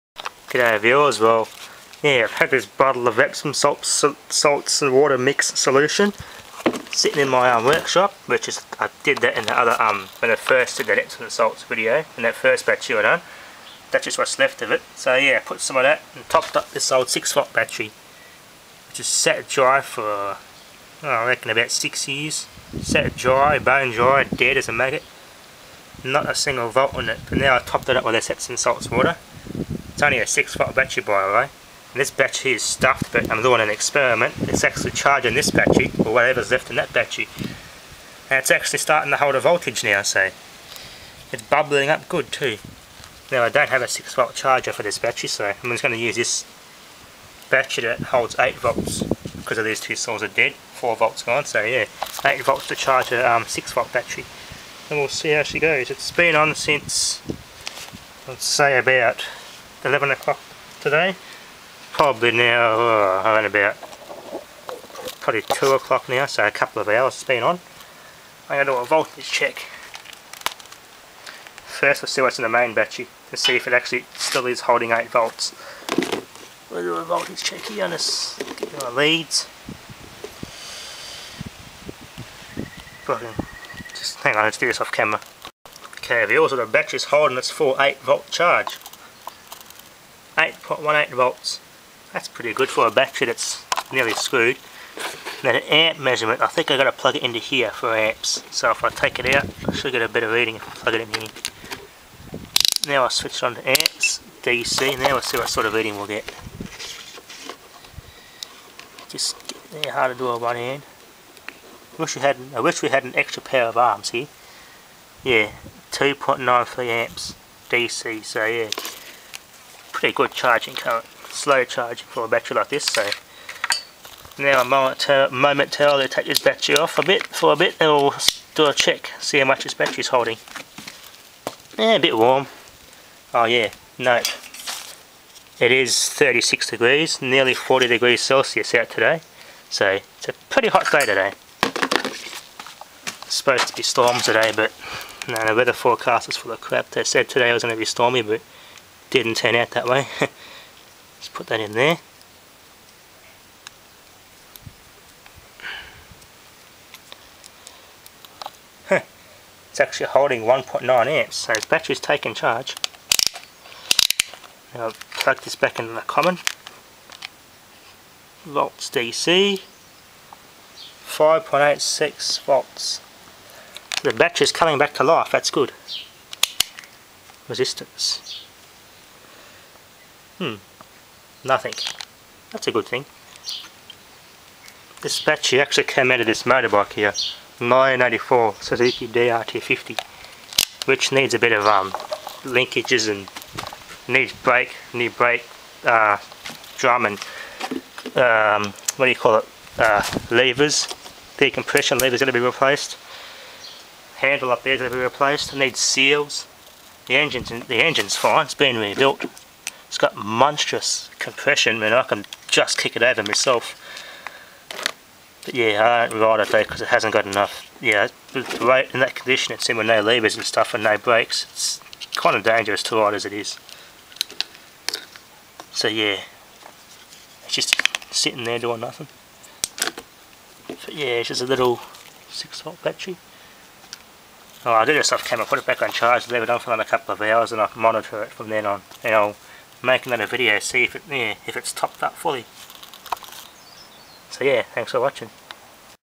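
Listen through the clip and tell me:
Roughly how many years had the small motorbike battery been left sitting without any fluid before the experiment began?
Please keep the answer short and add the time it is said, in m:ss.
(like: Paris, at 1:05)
6 years, at 0:21.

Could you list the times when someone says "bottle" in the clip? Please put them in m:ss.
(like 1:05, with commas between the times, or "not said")
0:02.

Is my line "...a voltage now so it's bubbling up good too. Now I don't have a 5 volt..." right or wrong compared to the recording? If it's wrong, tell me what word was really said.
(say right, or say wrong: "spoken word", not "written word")
wrong: "6", not "5".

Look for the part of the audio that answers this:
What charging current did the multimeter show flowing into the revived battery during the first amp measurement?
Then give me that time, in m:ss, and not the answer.
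1:55.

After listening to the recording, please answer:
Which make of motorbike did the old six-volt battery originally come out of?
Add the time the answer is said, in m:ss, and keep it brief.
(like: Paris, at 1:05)
Suzuki, at 3:08.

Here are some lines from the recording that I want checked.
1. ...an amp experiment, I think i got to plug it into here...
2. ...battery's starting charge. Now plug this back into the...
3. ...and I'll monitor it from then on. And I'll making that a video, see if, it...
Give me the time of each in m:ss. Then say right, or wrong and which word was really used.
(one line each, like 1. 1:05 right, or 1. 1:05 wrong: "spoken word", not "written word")
1. 1:35 wrong: "measurement", not "experiment"
2. 2:41 wrong: "taking", not "starting"
3. 3:57 right.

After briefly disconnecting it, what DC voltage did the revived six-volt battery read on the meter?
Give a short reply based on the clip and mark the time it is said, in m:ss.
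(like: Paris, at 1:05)
5.86 volts, at 2:51.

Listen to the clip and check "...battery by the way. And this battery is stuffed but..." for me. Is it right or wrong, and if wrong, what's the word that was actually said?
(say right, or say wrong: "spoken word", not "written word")
right.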